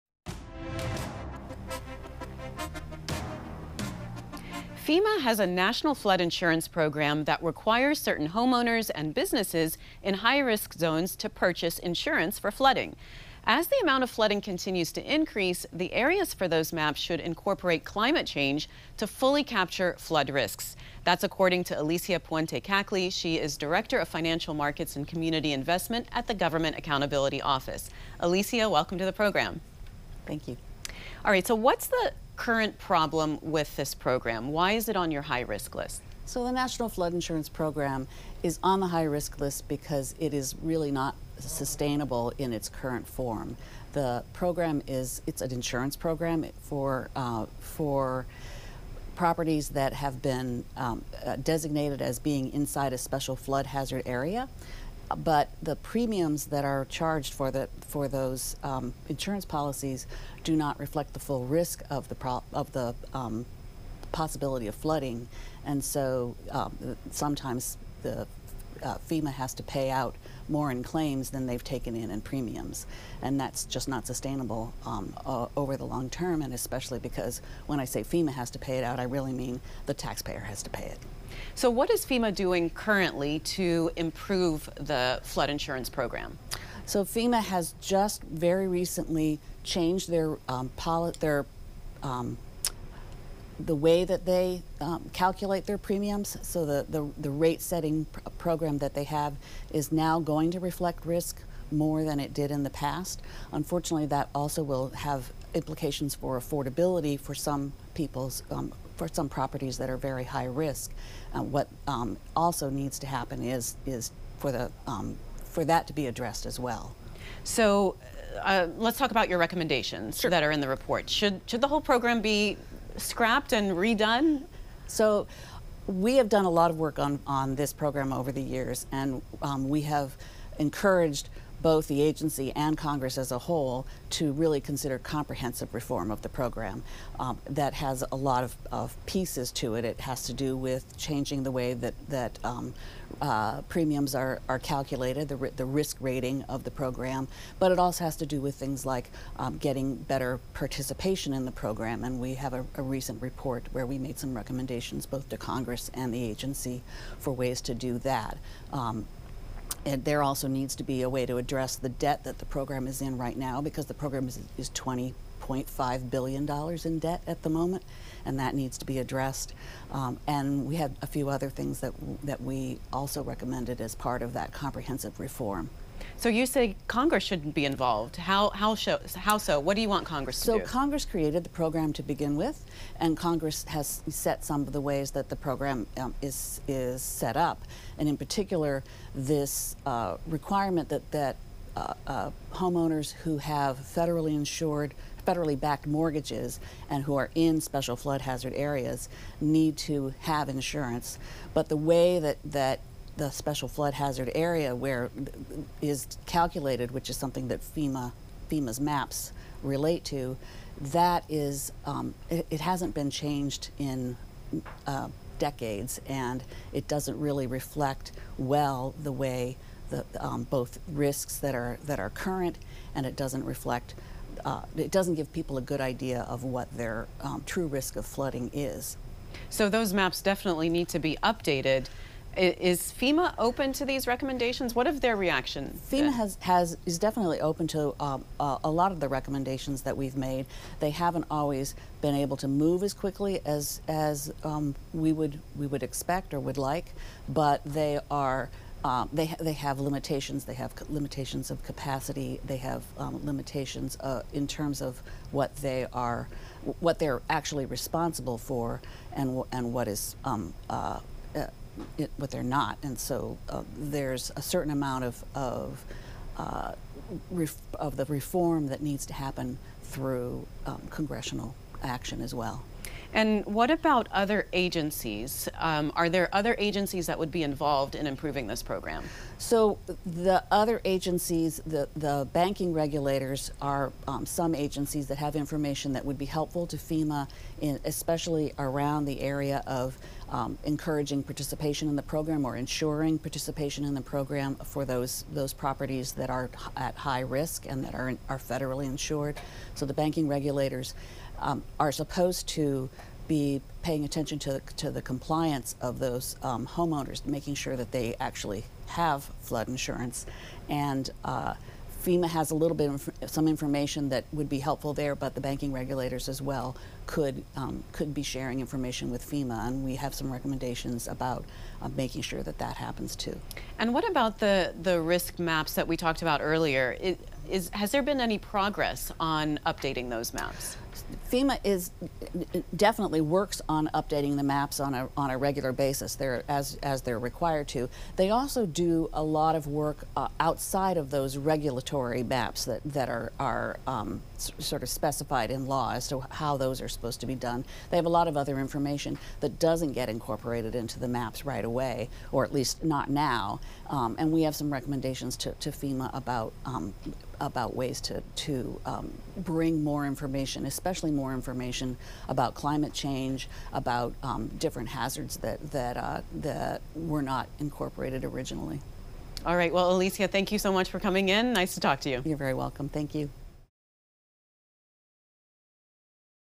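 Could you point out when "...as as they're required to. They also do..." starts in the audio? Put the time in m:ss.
5:36.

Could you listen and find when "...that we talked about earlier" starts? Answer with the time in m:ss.
5:25.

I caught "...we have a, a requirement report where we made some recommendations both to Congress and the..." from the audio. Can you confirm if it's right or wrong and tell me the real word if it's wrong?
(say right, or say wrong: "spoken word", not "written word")
wrong: "recent", not "requirement".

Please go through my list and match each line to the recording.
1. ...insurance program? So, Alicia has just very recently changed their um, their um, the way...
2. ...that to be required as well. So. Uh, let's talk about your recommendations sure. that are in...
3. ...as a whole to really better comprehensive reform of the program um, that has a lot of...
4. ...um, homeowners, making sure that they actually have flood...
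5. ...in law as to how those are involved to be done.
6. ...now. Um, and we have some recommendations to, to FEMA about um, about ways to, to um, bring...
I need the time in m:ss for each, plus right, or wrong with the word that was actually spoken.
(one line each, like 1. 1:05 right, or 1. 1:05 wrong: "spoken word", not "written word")
1. 1:25 wrong: "FEMA", not "Alicia"
2. 1:55 wrong: "addressed", not "required"
3. 2:13 wrong: "consider", not "better"
4. 5:06 right
5. 5:45 wrong: "supposed", not "involved"
6. 5:53 right.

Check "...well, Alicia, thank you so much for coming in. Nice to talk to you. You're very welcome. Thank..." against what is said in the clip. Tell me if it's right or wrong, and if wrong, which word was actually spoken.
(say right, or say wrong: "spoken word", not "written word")
right.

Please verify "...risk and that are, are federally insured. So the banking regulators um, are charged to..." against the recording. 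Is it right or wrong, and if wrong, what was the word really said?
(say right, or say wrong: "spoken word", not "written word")
wrong: "supposed", not "charged".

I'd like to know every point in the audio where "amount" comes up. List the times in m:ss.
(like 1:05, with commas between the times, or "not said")
0:13, 4:24.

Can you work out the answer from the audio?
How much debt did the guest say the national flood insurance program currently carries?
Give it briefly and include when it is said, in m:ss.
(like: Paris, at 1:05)
$20.5 billion, at 2:44.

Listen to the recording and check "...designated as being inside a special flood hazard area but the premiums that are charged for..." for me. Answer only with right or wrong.
right.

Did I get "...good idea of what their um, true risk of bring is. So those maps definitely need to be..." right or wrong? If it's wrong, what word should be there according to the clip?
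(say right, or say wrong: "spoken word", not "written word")
wrong: "flooding", not "bring".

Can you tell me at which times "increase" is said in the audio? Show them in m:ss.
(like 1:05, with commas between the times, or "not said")
0:15.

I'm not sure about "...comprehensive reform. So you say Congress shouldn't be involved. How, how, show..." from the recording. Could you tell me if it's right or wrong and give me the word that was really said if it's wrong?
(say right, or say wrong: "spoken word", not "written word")
right.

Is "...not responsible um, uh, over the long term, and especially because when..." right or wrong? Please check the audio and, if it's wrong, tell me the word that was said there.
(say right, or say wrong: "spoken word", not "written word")
wrong: "sustainable", not "responsible".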